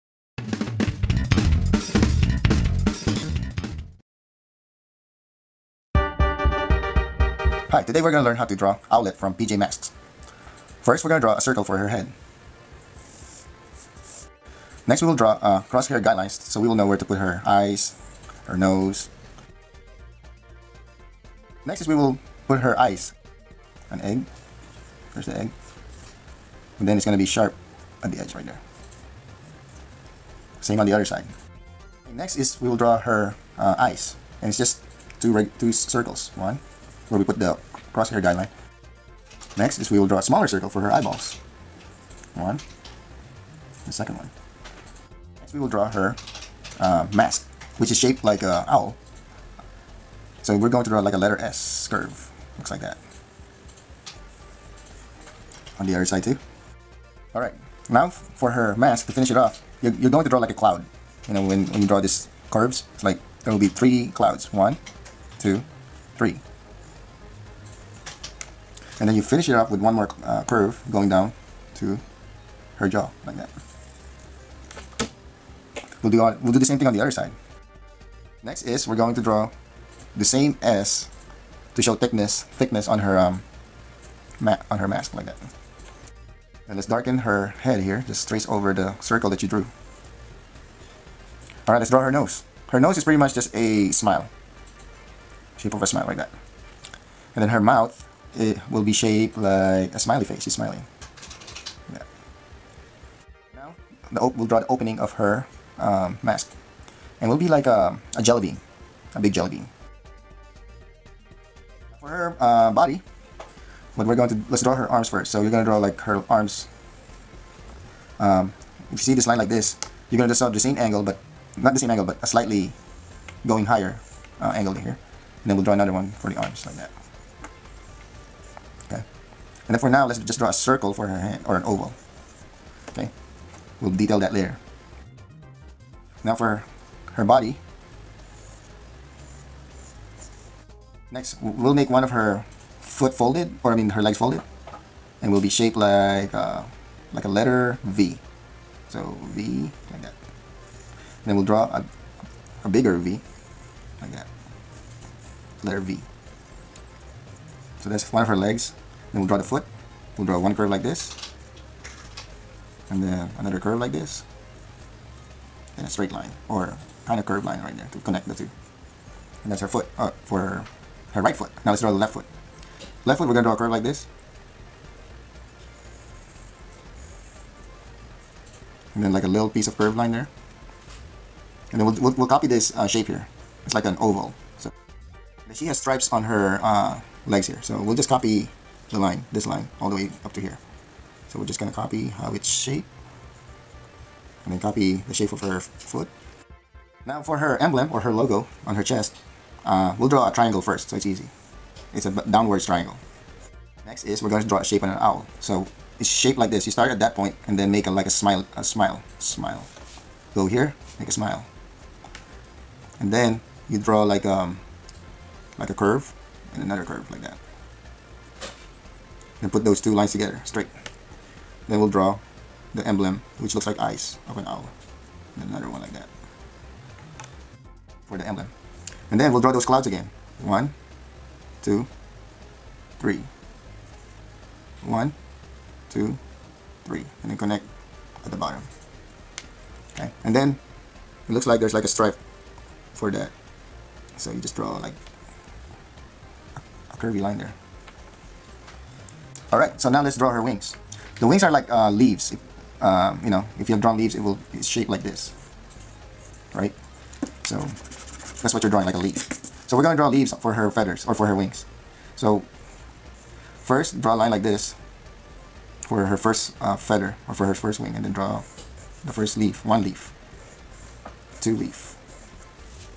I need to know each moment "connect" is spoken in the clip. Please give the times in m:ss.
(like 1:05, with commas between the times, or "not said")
2:48, 3:57.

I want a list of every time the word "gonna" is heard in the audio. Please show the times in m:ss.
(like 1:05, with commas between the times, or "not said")
0:27, 1:55, 2:00, 2:53, 3:11, 4:19.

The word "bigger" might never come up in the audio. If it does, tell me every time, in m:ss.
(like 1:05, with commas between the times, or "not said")
2:32.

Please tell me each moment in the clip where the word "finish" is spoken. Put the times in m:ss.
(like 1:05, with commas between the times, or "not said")
0:59, 1:09.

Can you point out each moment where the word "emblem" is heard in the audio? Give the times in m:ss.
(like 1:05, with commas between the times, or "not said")
3:17, 3:42, 3:48.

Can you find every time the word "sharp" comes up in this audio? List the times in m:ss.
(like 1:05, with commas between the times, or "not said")
0:27.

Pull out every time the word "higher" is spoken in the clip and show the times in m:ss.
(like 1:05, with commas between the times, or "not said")
2:03.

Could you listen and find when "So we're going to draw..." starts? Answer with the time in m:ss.
0:50.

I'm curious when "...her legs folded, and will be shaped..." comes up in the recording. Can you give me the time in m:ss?
2:23.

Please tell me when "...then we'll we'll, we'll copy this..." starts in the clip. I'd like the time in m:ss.
3:01.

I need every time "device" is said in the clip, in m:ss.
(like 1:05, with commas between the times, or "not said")
not said.